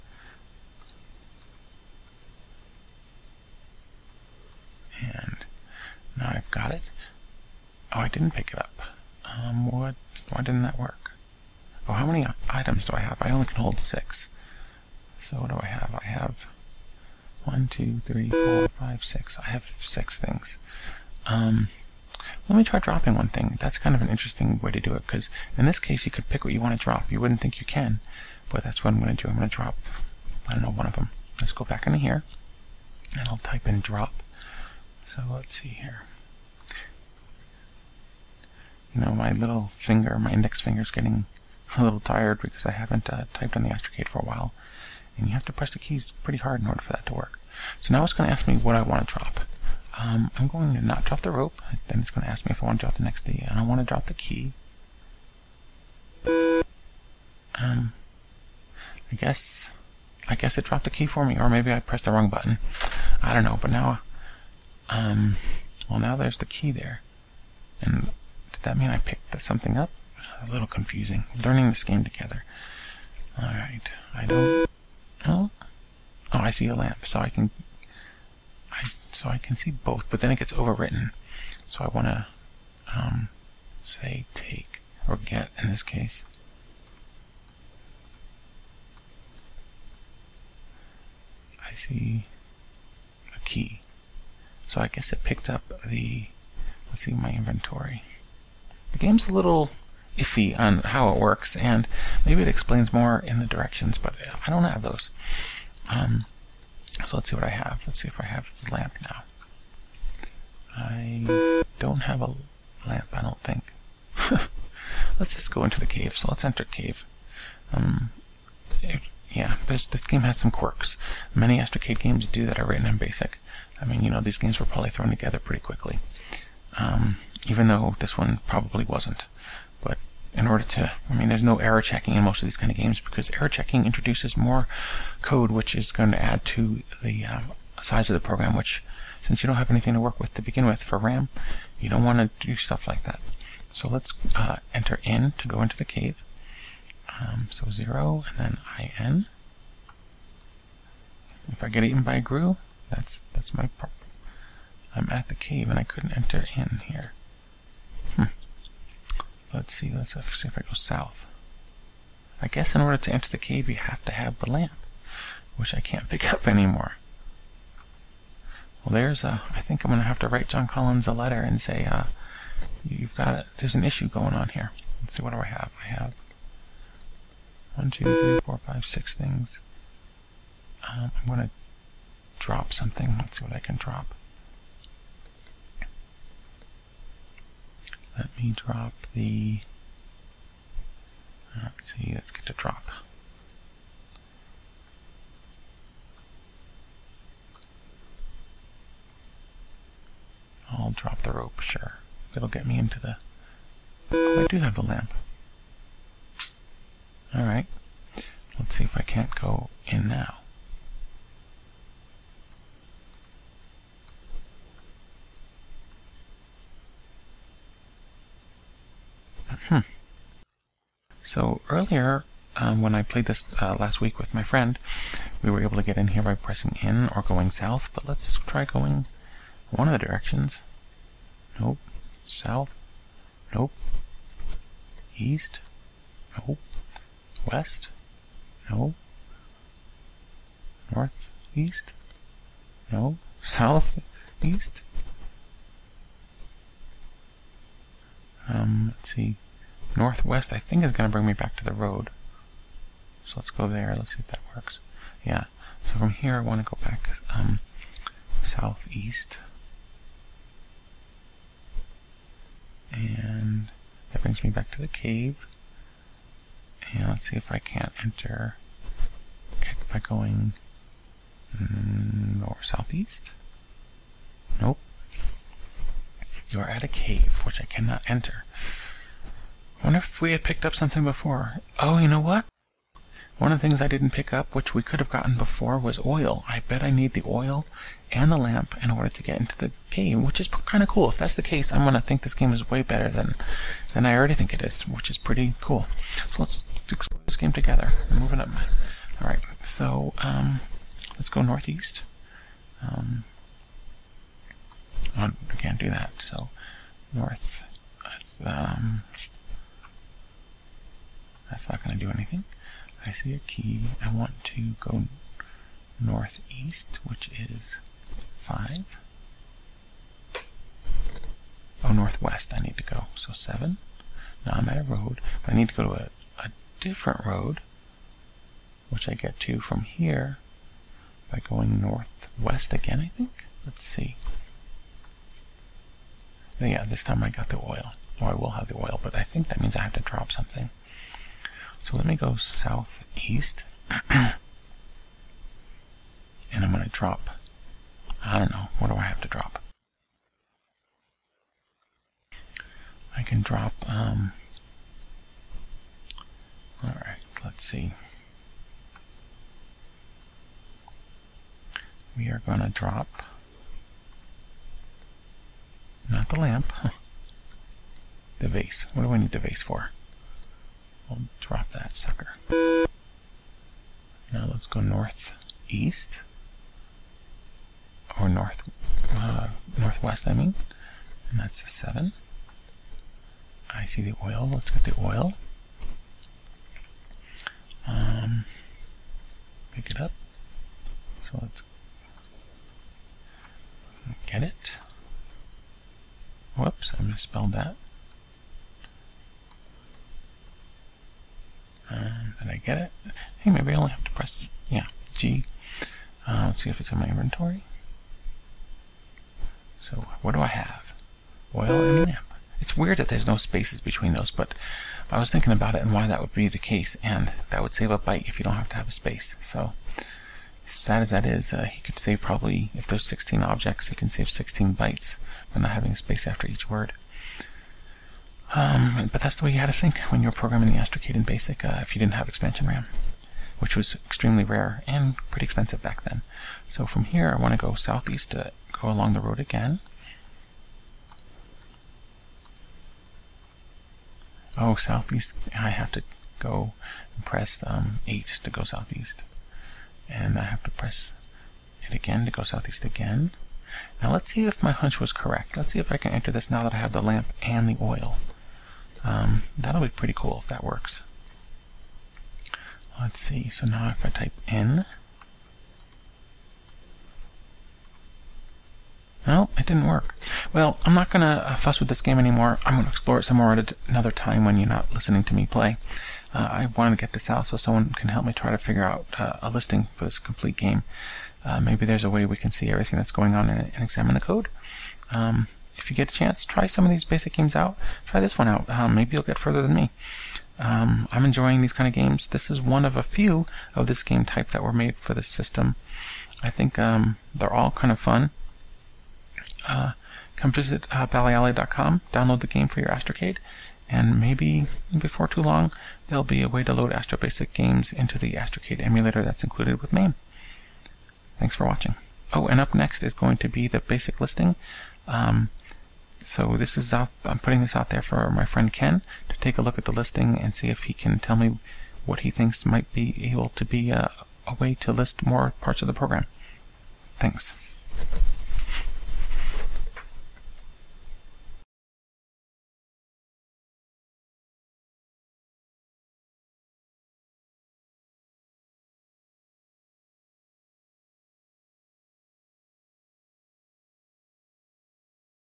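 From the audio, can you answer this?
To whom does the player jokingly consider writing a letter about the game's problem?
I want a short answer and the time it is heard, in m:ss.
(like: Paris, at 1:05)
John Collins, at 2:50.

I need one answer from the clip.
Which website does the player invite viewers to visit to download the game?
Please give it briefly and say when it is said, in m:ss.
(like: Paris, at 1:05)
ballyalley.com, at 8:21.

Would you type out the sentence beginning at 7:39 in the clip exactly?
Um, that'll be pretty cool if that works.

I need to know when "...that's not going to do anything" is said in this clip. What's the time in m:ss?
5:11.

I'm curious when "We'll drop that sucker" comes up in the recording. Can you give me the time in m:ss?
6:11.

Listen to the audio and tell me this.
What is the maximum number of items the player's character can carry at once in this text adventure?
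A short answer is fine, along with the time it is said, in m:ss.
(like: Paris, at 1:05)
6, at 0:13.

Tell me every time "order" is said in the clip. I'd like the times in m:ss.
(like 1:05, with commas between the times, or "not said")
0:46, 2:10, 2:42, 4:48.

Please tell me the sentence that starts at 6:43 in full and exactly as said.
Hey, maybe I only have to press, yeah, G.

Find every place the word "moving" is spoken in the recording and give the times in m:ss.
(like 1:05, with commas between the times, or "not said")
4:58.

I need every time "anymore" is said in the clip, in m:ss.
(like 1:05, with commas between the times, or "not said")
2:46, 7:52.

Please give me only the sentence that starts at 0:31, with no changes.
Let's go back into here, and I'll type in drop.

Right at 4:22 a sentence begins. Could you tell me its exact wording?
And that brings me back to the cave.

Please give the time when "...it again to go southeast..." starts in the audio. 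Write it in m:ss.
7:31.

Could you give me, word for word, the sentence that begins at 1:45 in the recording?
Um, so let's see what I have.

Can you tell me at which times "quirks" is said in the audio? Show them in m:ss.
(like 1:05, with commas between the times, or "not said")
2:00.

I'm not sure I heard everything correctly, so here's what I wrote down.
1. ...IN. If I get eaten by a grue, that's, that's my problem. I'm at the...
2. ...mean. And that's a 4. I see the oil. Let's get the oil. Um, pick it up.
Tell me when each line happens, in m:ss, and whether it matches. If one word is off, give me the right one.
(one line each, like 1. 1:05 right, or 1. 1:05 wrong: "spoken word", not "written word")
1. 2:28 right
2. 6:20 wrong: "7", not "4".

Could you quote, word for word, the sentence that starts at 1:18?
I, so I can see both, but then it gets overwritten.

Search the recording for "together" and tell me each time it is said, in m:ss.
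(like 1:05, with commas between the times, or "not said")
1:12, 2:05, 4:57.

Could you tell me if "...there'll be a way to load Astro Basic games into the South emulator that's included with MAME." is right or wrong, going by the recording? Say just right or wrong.
wrong.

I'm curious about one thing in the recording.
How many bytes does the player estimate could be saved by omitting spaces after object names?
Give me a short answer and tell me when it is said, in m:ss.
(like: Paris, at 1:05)
16, at 7:04.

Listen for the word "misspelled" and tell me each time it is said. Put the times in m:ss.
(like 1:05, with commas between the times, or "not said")
6:37.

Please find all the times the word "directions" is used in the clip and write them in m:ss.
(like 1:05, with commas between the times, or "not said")
1:43, 3:50.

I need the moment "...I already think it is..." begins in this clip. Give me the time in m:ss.
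4:54.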